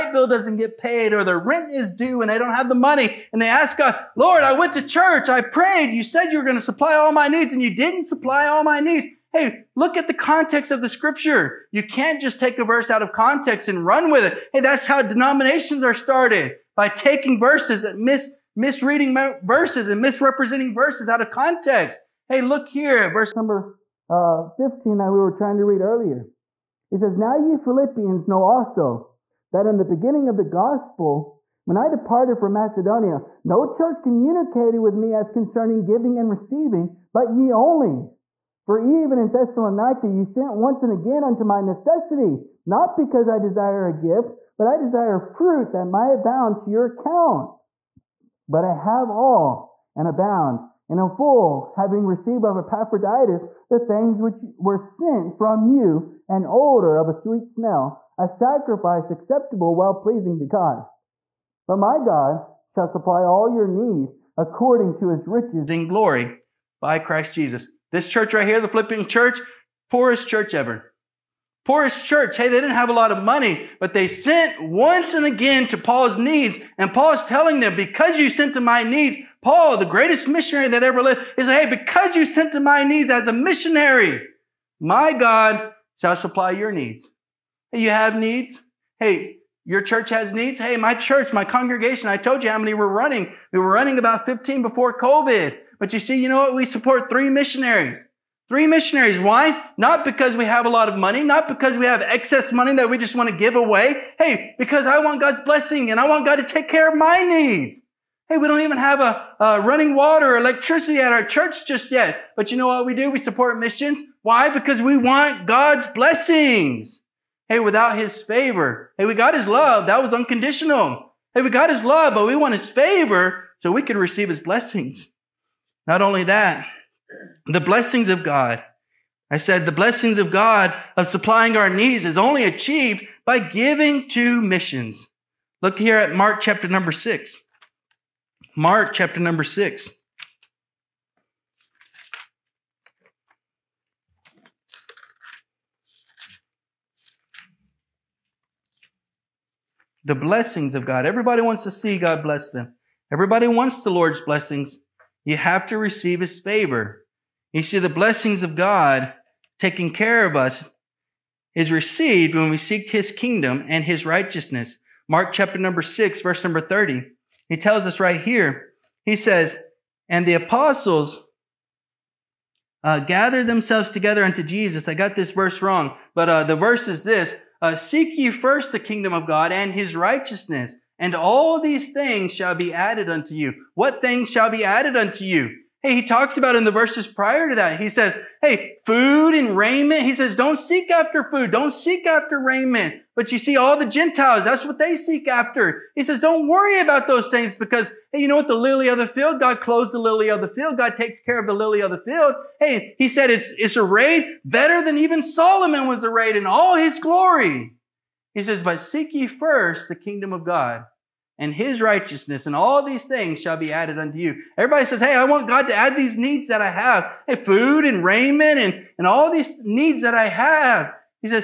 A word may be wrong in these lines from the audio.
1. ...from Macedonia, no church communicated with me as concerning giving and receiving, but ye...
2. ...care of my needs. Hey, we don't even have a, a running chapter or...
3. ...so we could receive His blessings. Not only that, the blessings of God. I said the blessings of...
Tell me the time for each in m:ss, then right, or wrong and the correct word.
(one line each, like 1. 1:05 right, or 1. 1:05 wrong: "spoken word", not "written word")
1. 0:32 right
2. 1:46 wrong: "water", not "chapter"
3. 2:03 right.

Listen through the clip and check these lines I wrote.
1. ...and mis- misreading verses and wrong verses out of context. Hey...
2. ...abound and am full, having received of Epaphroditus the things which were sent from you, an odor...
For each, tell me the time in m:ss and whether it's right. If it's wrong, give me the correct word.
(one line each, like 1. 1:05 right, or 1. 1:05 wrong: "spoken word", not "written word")
1. 0:17 wrong: "misrepresenting", not "wrong"
2. 0:50 right.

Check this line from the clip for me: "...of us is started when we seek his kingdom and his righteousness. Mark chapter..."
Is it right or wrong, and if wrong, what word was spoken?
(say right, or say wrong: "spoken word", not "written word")
wrong: "received", not "started".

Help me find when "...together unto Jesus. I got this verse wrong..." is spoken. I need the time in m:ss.
2:53.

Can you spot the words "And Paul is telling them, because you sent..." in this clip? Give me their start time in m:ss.
1:16.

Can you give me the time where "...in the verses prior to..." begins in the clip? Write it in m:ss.
3:06.